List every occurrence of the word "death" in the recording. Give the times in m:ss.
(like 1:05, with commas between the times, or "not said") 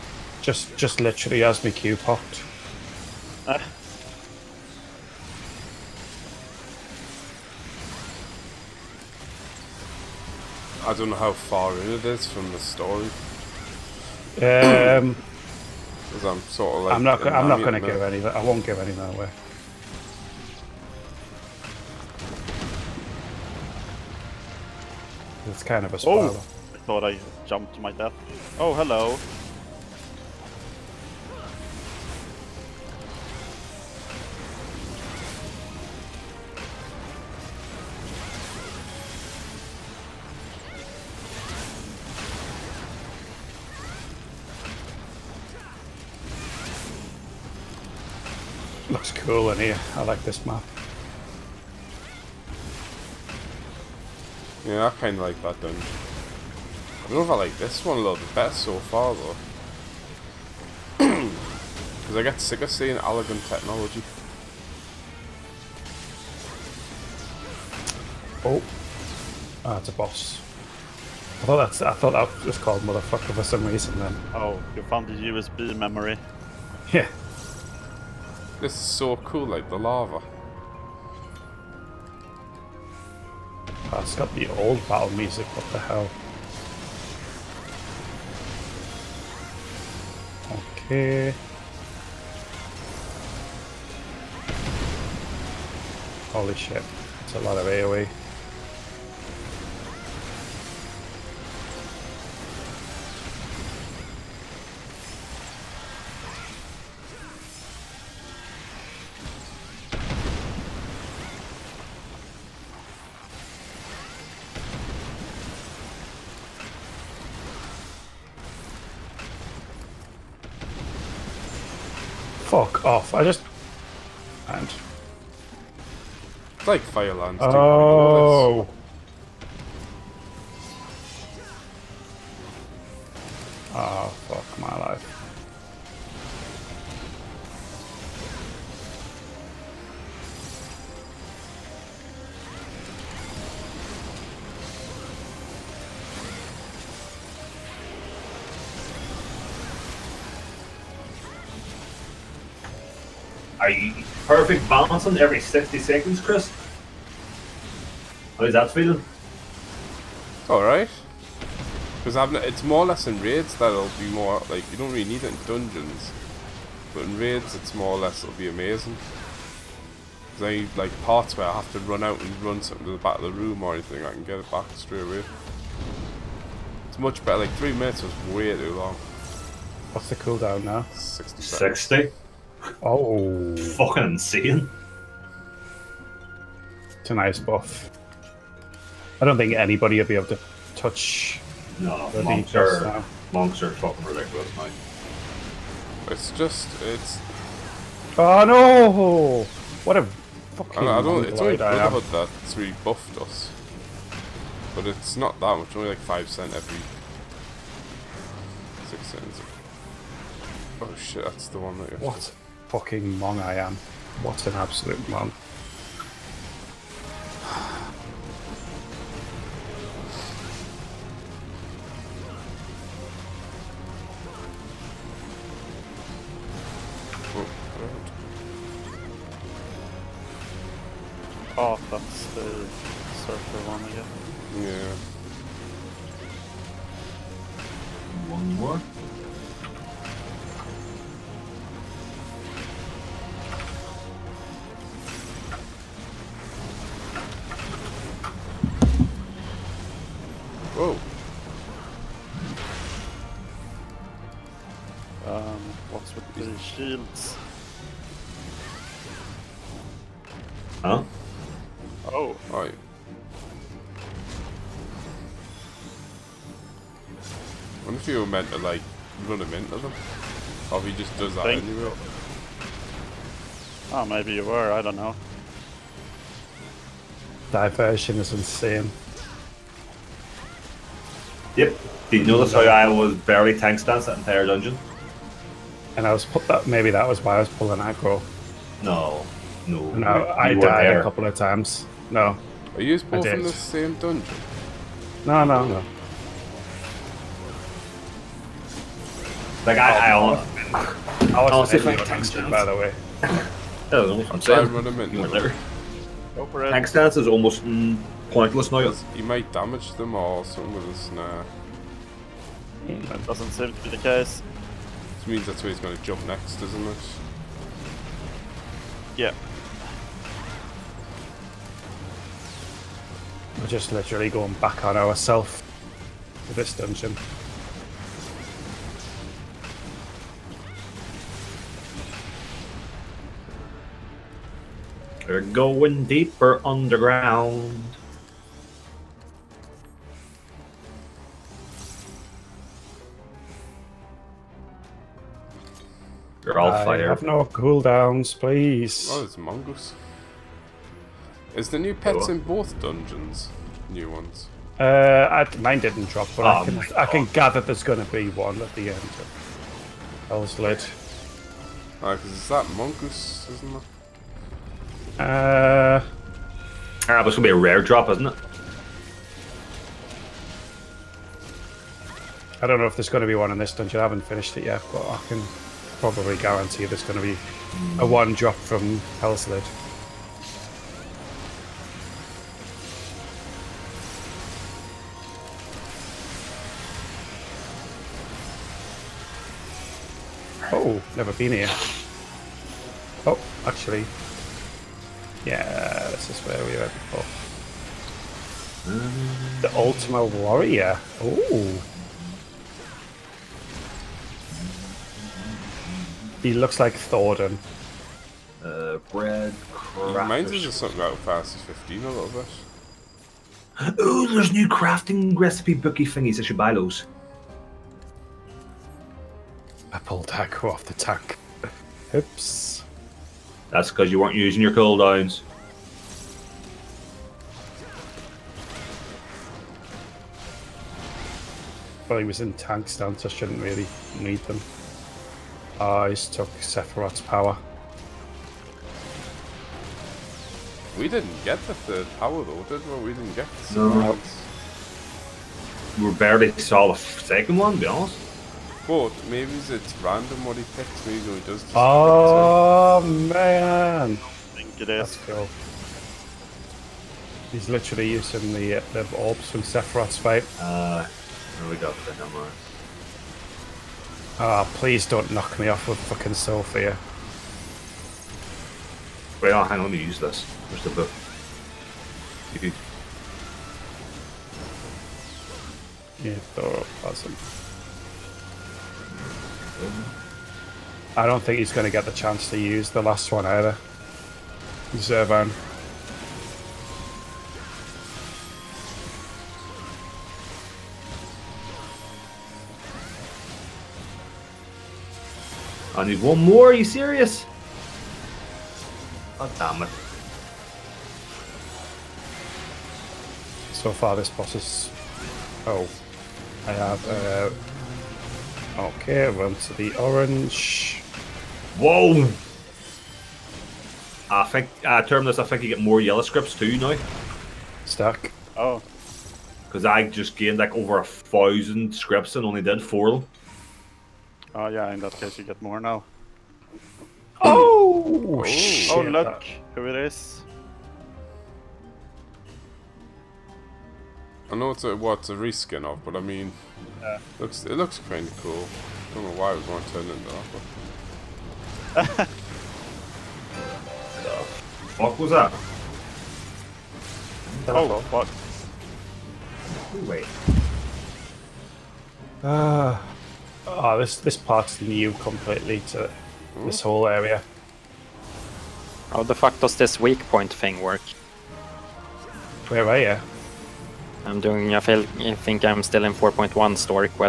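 0:27.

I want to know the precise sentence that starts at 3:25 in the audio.
Only like five cent every six cents.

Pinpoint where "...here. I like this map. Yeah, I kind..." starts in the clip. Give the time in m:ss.
0:49.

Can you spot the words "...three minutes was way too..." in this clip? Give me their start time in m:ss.
2:57.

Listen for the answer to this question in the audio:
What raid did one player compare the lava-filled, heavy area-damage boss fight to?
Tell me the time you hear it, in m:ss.
2:06.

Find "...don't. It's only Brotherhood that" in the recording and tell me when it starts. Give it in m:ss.
3:21.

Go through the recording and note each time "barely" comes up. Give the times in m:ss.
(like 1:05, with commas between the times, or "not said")
4:43, 7:26.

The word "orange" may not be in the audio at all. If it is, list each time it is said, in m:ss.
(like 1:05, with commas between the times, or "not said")
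8:29.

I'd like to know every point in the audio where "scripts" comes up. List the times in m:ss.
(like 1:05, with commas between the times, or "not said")
8:36, 8:41.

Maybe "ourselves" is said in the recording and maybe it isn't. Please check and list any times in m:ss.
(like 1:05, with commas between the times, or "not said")
5:24.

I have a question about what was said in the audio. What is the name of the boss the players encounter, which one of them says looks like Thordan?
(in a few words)
The Ultima Warrior.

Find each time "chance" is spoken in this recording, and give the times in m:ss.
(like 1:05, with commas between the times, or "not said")
8:02.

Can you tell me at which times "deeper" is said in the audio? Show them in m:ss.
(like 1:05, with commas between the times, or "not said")
5:36.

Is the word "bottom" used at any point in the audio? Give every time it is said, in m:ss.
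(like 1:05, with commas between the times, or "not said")
not said.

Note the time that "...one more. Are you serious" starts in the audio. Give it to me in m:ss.
8:16.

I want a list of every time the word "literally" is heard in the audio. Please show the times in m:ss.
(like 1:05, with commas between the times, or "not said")
0:01, 5:23, 7:37.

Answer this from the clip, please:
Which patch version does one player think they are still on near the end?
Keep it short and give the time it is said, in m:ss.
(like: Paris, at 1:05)
4.1, at 9:26.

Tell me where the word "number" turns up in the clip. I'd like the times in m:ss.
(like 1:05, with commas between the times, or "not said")
7:42.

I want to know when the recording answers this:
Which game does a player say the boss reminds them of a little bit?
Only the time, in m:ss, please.
6:51.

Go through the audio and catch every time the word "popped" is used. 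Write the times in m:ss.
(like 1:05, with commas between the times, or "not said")
0:01.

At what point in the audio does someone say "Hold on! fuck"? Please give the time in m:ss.
9:07.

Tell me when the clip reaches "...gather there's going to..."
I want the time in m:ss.
5:57.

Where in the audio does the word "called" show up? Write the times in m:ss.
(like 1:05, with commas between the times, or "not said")
1:12.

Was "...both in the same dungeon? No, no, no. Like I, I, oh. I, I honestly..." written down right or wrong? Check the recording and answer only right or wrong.
right.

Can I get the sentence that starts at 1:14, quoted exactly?
Oh, you found the USB memory.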